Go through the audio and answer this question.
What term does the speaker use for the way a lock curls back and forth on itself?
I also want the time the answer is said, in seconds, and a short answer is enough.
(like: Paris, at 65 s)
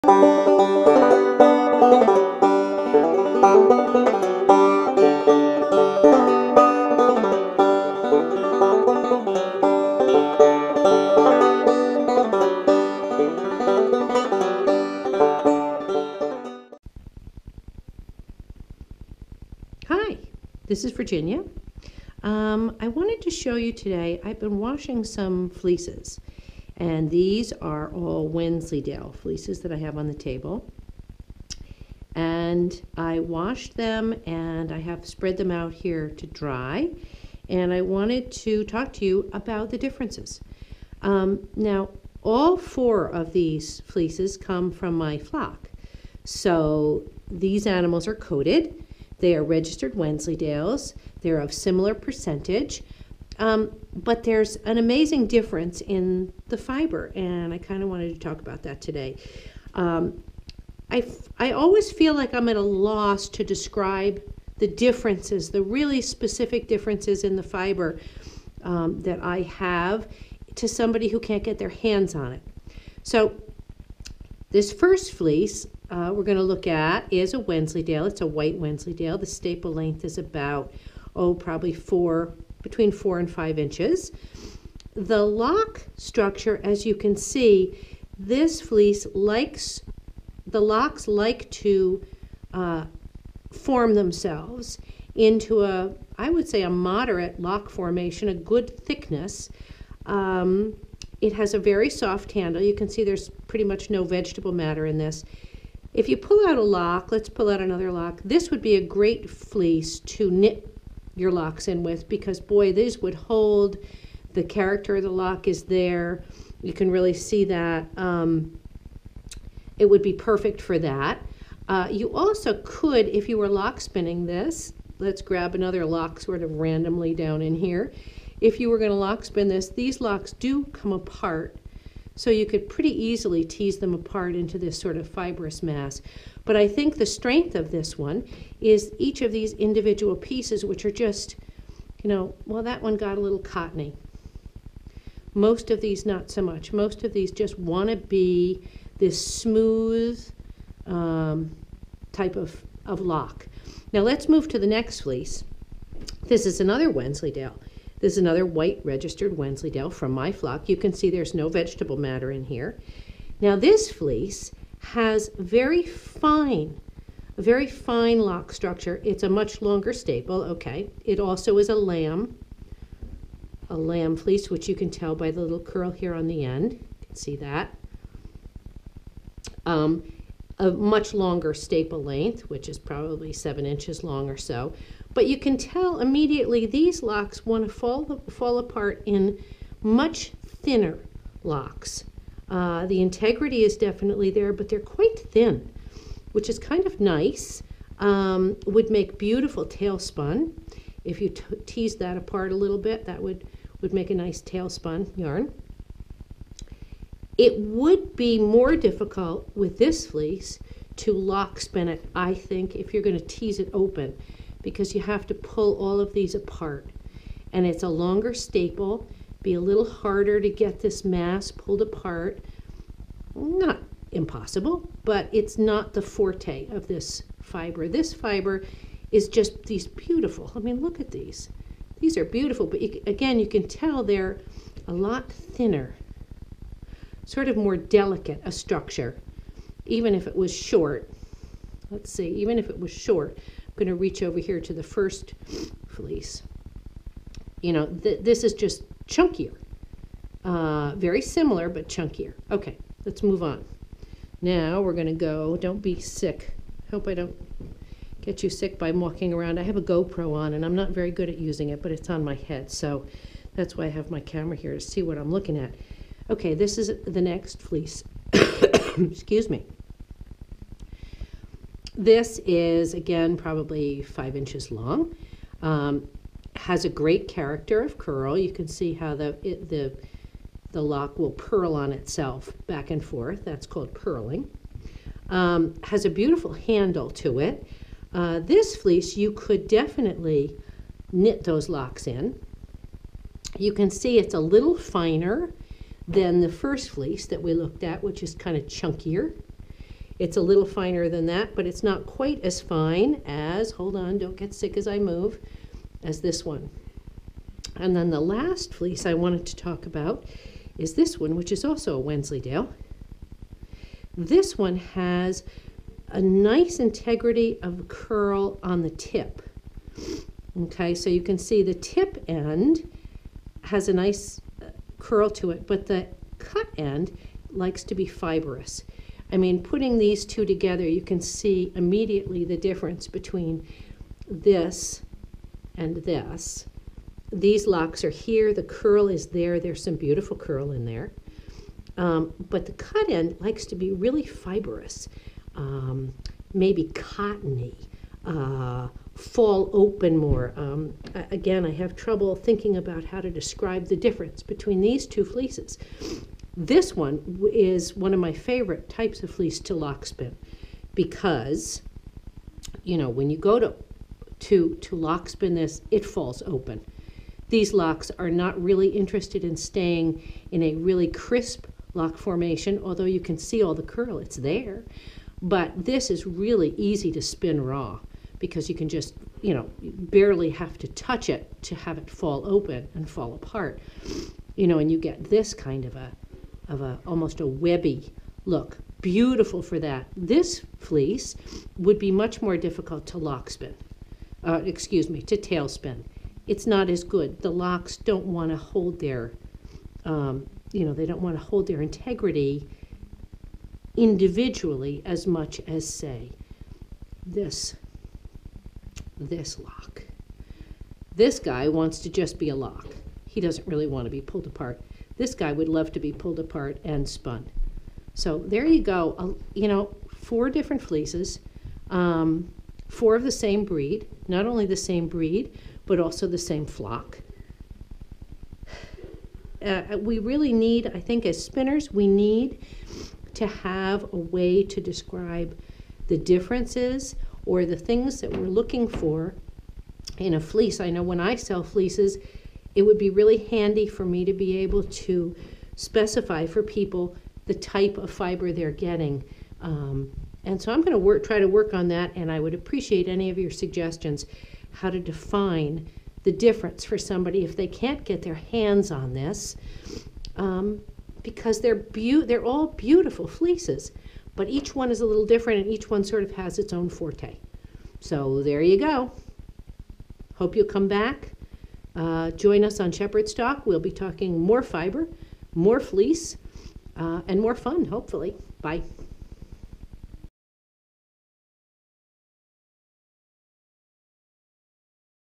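Purling, at 283 s.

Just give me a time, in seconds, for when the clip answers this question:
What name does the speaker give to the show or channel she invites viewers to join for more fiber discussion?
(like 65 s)
472 s.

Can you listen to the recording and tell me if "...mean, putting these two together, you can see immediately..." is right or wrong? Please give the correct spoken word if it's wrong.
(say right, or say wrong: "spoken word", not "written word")
right.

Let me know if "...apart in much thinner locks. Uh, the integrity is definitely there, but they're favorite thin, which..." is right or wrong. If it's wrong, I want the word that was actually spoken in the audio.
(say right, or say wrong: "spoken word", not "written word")
wrong: "quite", not "favorite".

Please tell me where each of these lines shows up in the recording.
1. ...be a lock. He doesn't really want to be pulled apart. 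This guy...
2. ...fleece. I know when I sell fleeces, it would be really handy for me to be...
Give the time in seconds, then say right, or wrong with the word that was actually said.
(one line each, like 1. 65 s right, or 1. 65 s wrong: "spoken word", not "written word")
1. 412 s right
2. 440 s right.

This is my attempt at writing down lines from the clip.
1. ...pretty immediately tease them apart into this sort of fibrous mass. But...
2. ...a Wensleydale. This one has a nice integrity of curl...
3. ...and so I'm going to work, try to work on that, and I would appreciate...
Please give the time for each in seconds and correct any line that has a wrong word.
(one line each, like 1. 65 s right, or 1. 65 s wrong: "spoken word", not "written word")
1. 132 s wrong: "easily", not "immediately"
2. 311 s right
3. 450 s right.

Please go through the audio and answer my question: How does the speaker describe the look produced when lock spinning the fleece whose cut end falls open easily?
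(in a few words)
Webby.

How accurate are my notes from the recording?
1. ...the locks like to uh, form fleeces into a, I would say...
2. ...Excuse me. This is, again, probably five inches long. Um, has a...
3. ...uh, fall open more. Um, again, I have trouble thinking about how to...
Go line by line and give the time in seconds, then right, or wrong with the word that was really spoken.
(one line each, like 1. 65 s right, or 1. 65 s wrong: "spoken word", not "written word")
1. 90 s wrong: "themselves", not "fleeces"
2. 268 s right
3. 348 s right.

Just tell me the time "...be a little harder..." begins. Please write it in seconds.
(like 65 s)
219 s.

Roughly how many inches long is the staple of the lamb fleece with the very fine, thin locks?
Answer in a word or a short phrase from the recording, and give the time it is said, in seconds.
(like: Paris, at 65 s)
7, at 183 s.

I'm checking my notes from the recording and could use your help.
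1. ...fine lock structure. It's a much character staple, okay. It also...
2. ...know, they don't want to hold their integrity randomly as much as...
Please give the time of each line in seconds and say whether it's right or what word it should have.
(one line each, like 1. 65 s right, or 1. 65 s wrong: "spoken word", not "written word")
1. 167 s wrong: "longer", not "character"
2. 400 s wrong: "individually", not "randomly".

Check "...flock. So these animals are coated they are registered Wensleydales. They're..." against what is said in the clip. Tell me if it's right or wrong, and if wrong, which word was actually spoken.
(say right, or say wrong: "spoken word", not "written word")
right.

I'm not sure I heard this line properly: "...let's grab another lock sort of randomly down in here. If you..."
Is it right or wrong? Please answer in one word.
right.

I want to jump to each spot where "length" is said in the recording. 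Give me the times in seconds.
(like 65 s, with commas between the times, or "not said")
79 s, 182 s.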